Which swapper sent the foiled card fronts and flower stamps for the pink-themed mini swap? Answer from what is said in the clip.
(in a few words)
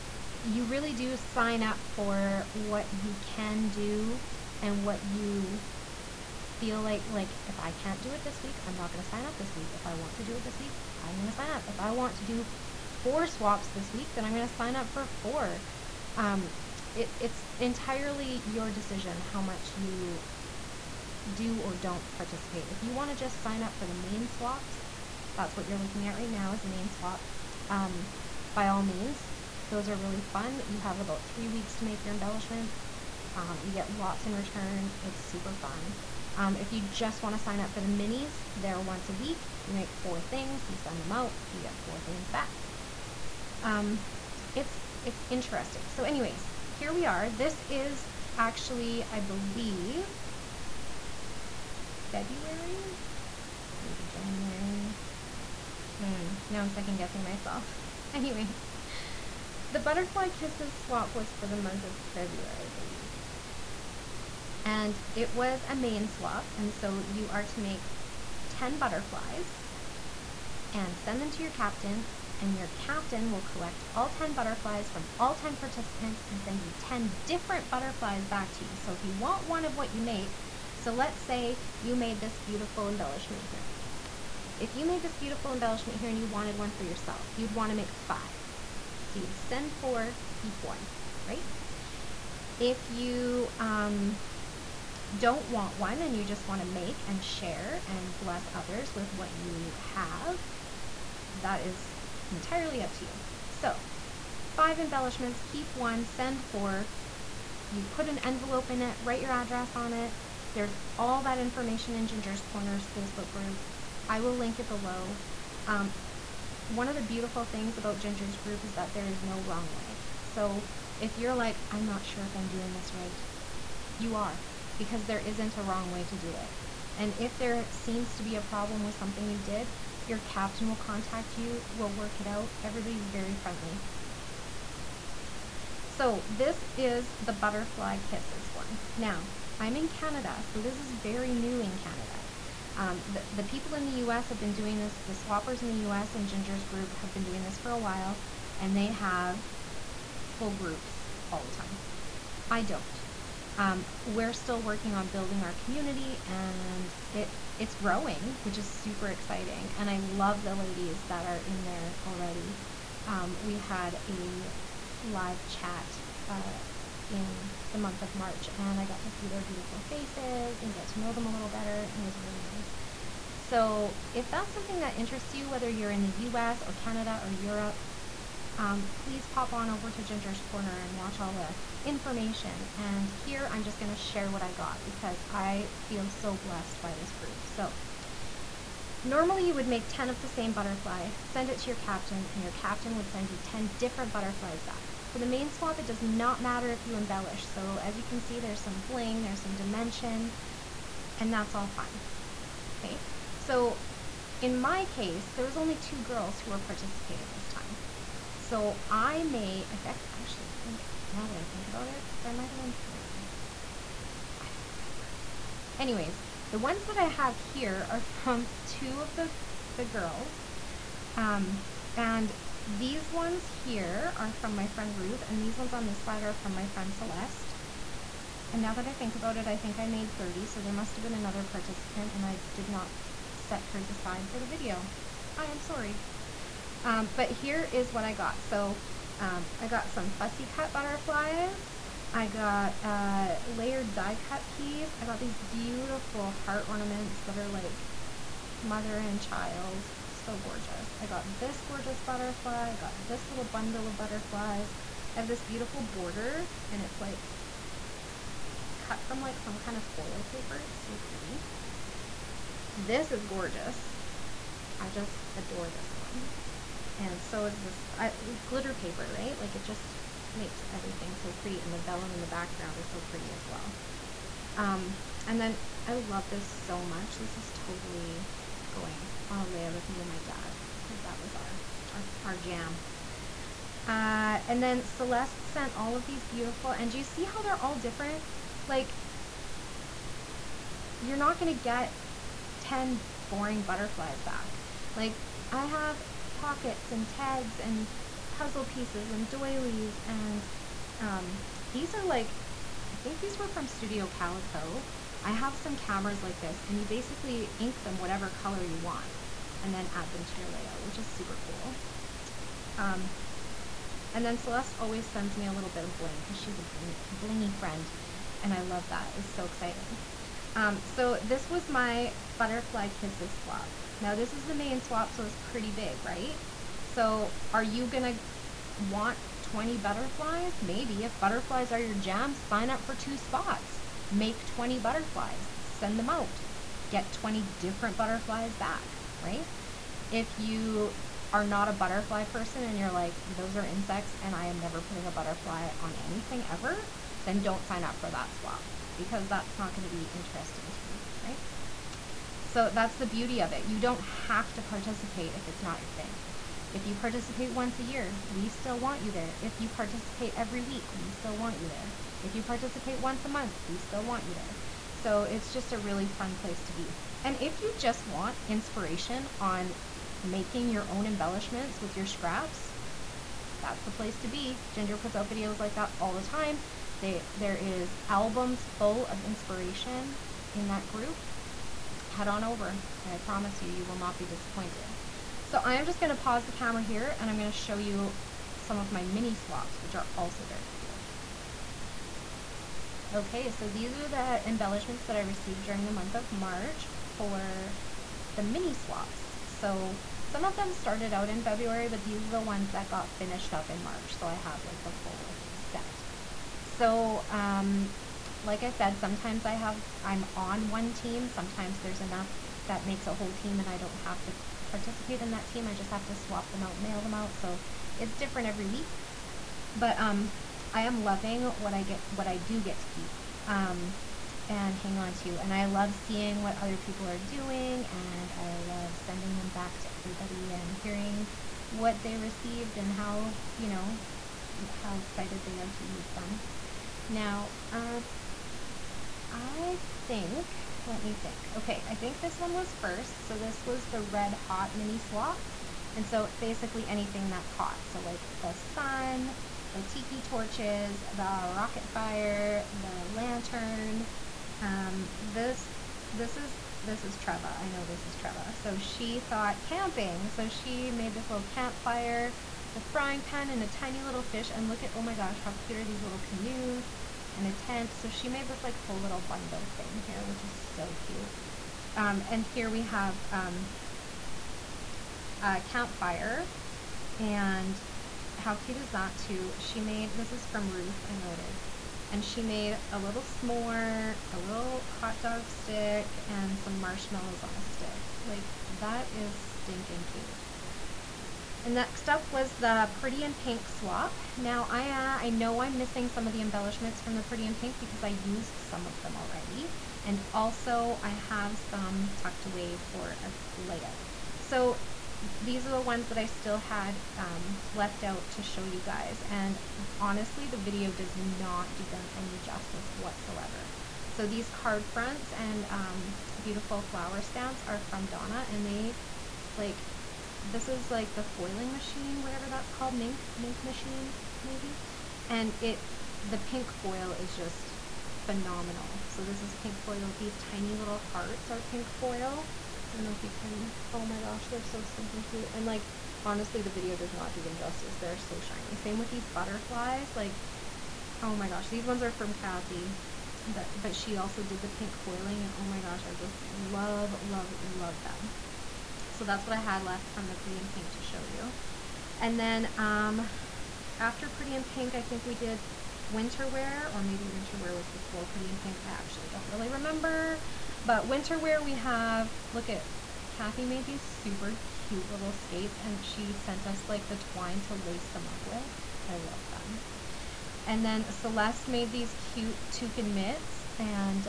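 Donna.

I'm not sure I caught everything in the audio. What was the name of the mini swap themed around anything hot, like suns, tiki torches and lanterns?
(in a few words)
Red Hot.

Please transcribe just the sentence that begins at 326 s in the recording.
So are you gonna want 20 butterflies?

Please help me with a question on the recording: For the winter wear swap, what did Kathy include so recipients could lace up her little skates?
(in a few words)
twine.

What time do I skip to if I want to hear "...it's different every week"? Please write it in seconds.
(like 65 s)
417 s.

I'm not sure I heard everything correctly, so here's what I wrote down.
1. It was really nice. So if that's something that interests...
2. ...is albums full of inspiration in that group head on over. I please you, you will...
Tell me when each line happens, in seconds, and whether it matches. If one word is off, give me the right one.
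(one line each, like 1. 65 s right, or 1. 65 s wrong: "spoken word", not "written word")
1. 171 s right
2. 377 s wrong: "promise", not "please".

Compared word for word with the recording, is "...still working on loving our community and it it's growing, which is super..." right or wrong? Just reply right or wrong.
wrong.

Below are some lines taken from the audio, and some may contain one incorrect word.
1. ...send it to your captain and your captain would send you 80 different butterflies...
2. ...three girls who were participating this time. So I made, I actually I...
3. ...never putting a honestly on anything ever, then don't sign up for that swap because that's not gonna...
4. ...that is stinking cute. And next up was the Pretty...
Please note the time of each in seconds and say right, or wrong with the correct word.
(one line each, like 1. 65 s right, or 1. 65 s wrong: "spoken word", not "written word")
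1. 191 s wrong: "10", not "80"
2. 205 s wrong: "two", not "three"
3. 344 s wrong: "butterfly", not "honestly"
4. 488 s right.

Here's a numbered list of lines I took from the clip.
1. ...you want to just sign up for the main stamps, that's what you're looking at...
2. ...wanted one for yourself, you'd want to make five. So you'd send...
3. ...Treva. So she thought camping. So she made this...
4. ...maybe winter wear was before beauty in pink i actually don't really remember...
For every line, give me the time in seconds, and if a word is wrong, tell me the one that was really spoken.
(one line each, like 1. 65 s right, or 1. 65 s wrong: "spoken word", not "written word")
1. 22 s wrong: "swaps", not "stamps"
2. 86 s right
3. 458 s right
4. 557 s wrong: "pretty", not "beauty".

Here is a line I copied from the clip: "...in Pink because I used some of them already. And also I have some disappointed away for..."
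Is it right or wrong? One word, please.
wrong.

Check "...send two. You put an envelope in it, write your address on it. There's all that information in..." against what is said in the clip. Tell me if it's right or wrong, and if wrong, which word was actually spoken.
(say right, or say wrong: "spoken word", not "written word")
wrong: "four", not "two".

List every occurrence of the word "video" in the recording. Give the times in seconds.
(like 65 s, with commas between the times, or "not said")
234 s, 375 s, 510 s, 536 s.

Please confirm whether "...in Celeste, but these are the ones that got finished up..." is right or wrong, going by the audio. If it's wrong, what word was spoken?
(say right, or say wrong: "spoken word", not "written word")
wrong: "February", not "Celeste".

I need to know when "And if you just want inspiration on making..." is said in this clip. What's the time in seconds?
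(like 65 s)
367 s.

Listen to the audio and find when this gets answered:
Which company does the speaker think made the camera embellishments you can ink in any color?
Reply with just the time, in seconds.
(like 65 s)
303 s.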